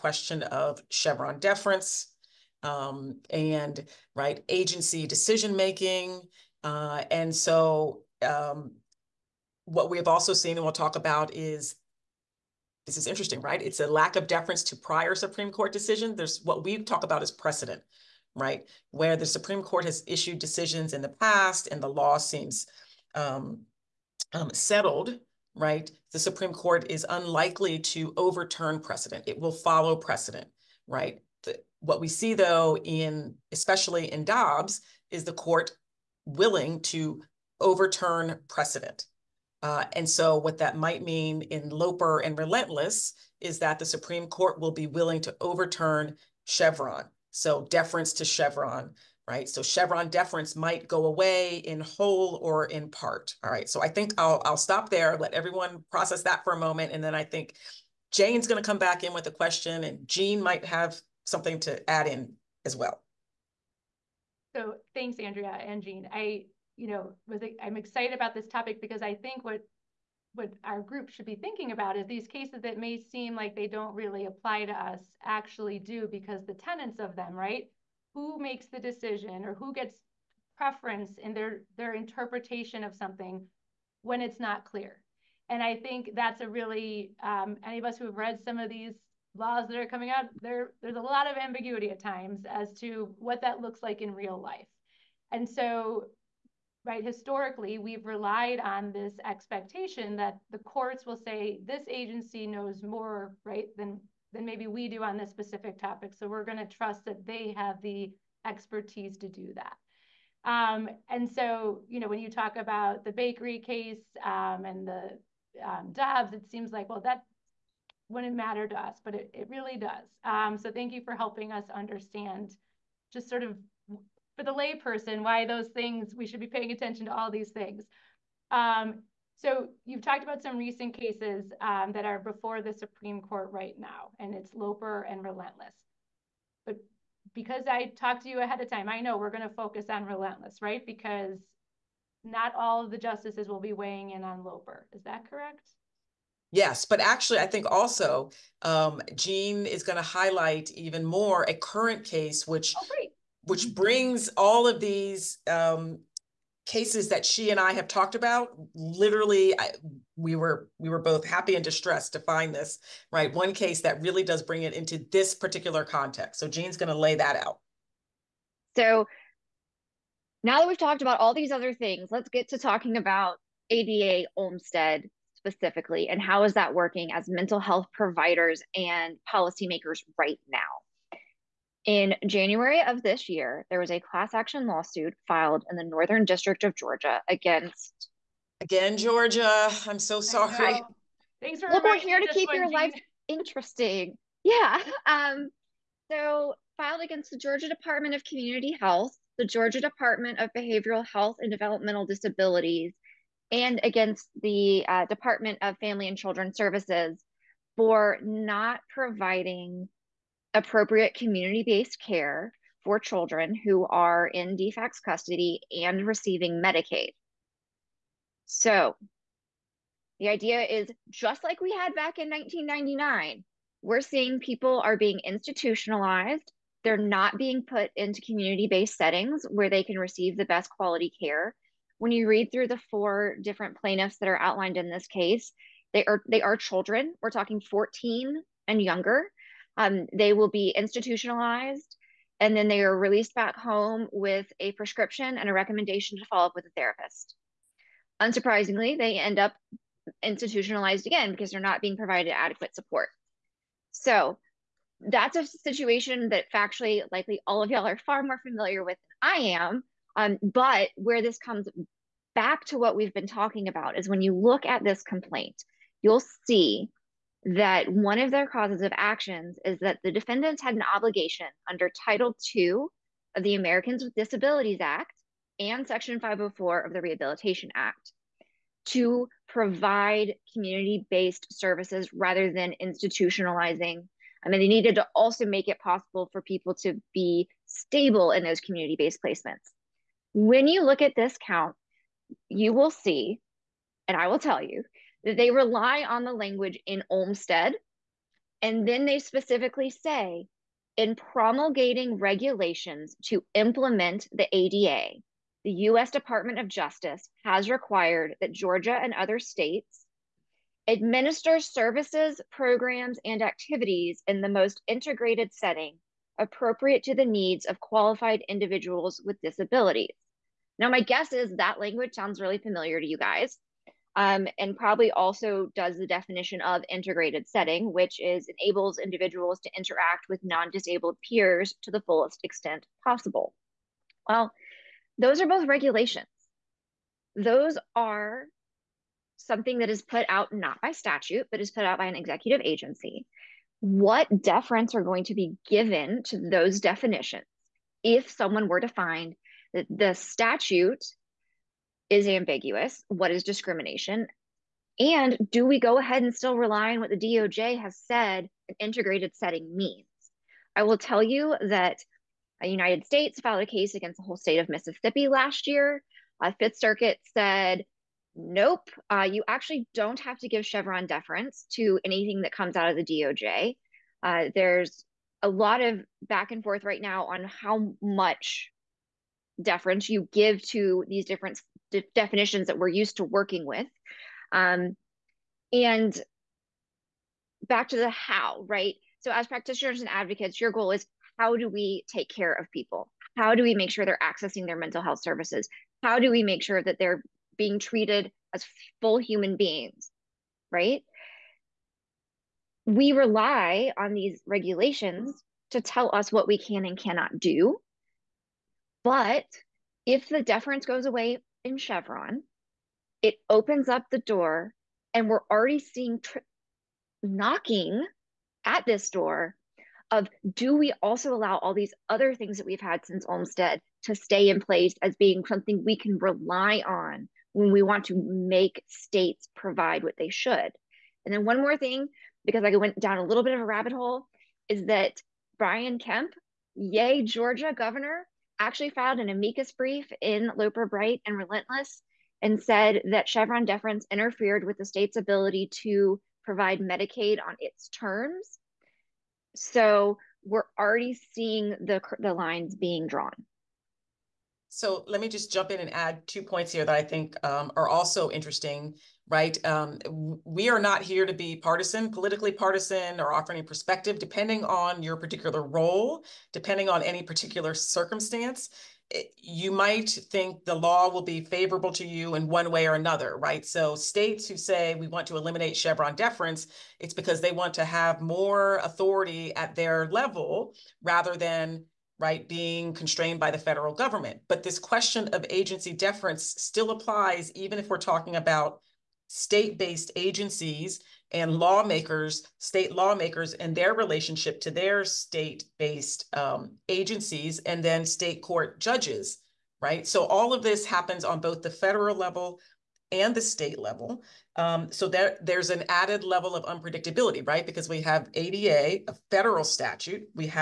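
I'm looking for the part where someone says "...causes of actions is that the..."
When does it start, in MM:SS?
04:28.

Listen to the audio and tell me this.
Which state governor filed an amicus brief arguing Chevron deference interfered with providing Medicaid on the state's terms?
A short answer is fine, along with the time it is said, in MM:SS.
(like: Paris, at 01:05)
Brian Kemp, at 07:15.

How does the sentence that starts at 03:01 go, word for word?
In January of this year, there was a class action lawsuit filed in the Northern District of Georgia against.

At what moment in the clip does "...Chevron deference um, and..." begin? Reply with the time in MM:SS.
00:00.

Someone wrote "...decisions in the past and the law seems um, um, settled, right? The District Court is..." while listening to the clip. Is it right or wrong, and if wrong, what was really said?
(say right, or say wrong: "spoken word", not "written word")
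wrong: "Supreme", not "District".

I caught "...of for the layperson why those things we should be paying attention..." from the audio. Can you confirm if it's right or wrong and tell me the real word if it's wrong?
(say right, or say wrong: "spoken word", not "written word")
right.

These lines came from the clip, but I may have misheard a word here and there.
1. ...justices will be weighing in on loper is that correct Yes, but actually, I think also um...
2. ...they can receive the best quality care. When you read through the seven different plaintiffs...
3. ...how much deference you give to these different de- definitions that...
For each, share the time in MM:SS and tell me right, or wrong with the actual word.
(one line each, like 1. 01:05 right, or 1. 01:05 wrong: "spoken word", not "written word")
1. 02:22 right
2. 03:49 wrong: "four", not "seven"
3. 06:17 right.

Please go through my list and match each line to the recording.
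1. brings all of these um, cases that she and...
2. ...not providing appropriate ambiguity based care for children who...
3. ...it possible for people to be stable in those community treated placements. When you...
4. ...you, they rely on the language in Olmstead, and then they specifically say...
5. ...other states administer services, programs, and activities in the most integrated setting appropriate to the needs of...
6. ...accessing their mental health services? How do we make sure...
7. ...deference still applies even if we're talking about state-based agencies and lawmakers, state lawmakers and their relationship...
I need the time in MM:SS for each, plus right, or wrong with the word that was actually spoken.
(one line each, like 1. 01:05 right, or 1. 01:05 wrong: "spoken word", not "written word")
1. 02:33 right
2. 03:28 wrong: "community", not "ambiguity"
3. 04:45 wrong: "based", not "treated"
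4. 04:54 right
5. 05:09 right
6. 06:34 right
7. 08:05 right.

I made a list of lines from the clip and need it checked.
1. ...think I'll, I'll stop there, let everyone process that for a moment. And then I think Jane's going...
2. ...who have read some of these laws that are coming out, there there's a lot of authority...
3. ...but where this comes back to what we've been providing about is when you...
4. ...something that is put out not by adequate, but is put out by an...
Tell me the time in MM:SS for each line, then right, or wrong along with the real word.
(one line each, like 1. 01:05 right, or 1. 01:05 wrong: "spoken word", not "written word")
1. 00:53 right
2. 01:27 wrong: "ambiguity", not "authority"
3. 04:20 wrong: "talking", not "providing"
4. 05:39 wrong: "statute", not "adequate".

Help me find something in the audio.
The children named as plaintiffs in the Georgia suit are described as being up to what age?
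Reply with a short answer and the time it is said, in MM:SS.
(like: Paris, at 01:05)
14, at 03:57.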